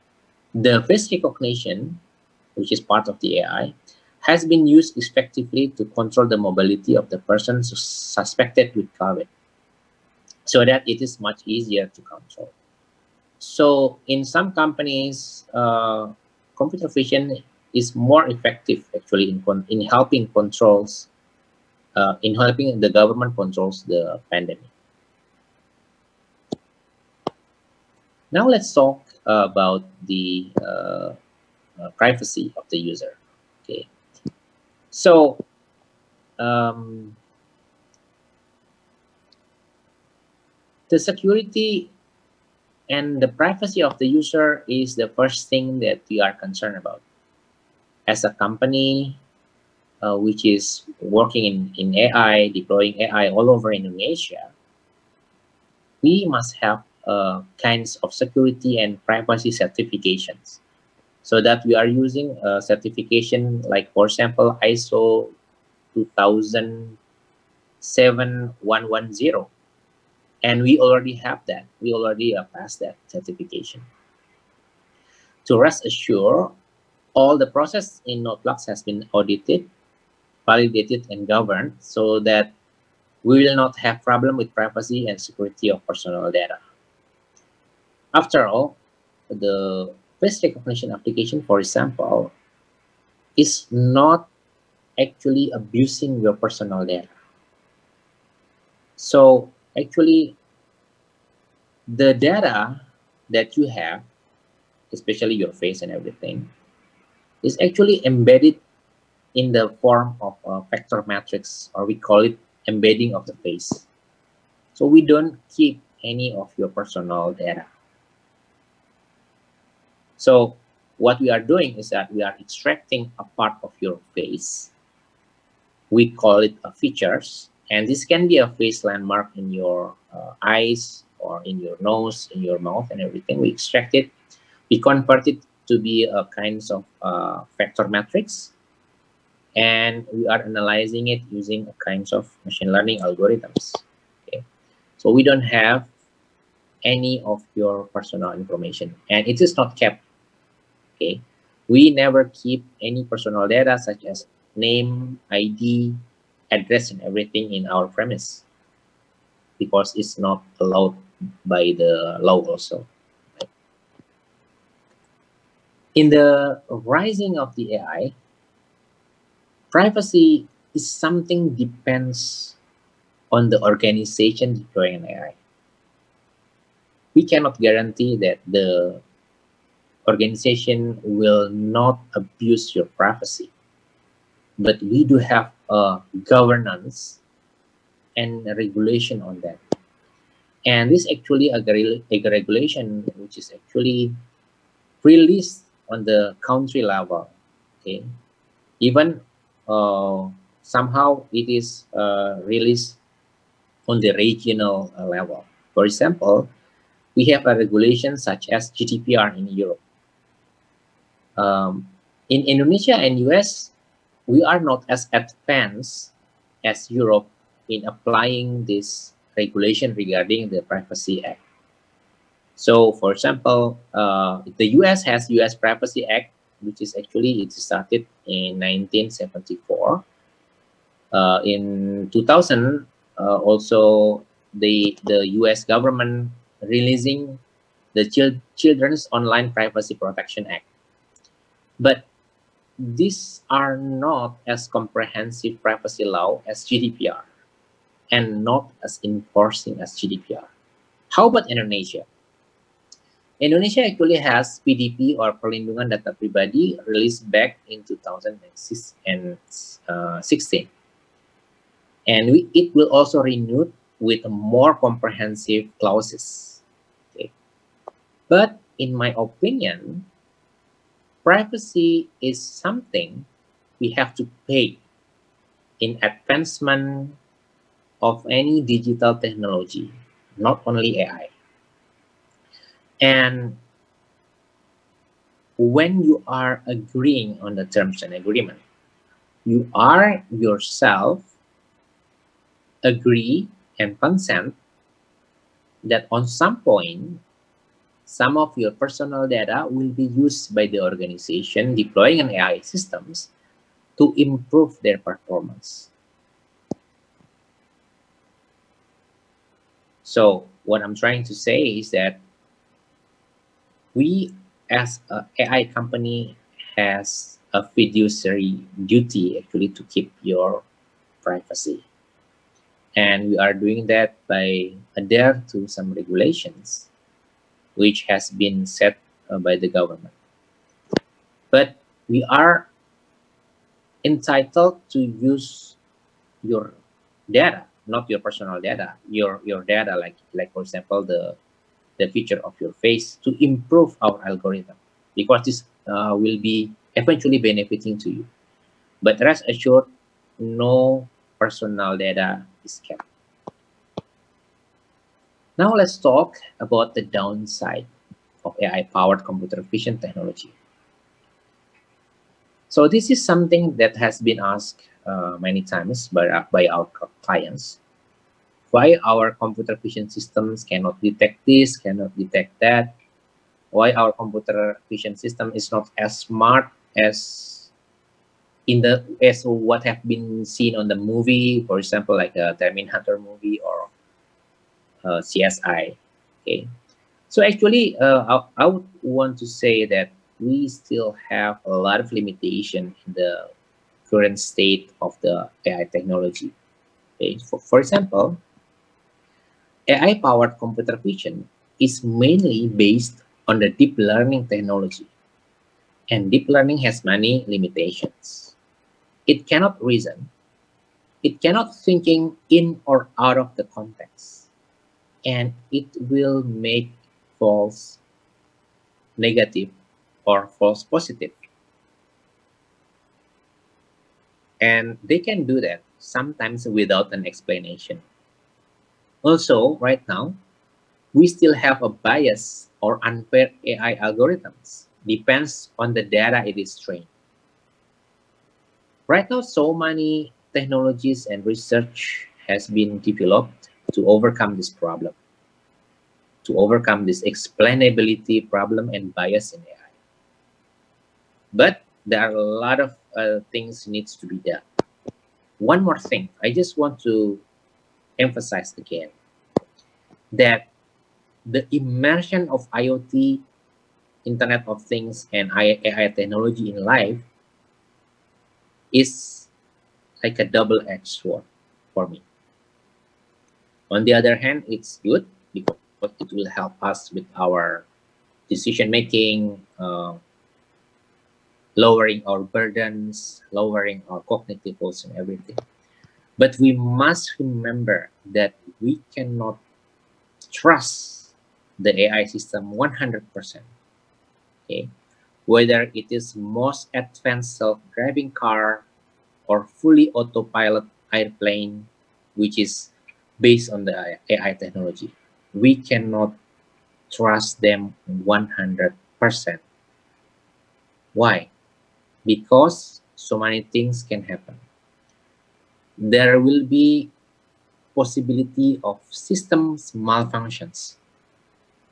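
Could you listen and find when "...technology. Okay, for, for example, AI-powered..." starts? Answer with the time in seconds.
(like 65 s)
395 s.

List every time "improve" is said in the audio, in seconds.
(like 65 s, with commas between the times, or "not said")
304 s, 343 s.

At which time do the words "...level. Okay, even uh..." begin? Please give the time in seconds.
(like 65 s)
196 s.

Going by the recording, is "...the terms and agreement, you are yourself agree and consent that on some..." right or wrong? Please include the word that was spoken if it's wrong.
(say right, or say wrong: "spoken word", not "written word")
right.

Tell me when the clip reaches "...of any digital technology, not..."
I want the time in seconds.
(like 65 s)
278 s.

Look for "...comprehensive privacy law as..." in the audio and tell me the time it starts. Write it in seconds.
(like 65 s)
244 s.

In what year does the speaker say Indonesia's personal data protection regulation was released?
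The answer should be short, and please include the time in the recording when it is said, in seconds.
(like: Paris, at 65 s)
2016, at 257 s.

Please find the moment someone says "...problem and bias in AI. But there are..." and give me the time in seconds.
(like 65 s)
448 s.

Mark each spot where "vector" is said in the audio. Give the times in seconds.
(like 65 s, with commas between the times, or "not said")
110 s, 137 s.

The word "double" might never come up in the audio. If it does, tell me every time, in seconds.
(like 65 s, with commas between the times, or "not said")
470 s.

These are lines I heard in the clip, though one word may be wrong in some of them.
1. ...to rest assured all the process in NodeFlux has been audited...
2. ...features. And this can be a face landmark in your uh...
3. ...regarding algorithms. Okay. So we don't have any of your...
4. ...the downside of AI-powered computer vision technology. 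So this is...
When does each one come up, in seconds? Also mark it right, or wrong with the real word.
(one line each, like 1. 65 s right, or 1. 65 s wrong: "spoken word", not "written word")
1. 75 s right
2. 126 s right
3. 142 s wrong: "learning", not "regarding"
4. 356 s right.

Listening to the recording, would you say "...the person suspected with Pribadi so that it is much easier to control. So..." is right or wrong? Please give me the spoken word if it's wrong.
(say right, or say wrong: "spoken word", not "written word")
wrong: "COVID", not "Pribadi".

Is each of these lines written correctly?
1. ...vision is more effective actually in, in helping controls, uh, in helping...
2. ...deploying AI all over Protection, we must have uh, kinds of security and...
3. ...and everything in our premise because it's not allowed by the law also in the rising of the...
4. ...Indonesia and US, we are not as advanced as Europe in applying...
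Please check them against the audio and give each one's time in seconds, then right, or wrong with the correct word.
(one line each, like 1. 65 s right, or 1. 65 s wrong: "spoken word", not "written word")
1. 16 s right
2. 52 s wrong: "Indonesia", not "Protection"
3. 156 s right
4. 212 s right.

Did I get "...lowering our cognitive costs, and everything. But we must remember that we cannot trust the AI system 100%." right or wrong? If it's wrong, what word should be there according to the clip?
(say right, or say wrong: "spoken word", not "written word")
right.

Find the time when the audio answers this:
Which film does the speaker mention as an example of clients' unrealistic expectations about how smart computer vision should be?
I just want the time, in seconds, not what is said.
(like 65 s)
382 s.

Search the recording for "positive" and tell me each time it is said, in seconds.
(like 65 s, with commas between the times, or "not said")
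420 s.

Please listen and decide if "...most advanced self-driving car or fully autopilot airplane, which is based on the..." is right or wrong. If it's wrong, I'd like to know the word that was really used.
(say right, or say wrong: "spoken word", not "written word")
right.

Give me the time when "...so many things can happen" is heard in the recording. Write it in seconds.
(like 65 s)
513 s.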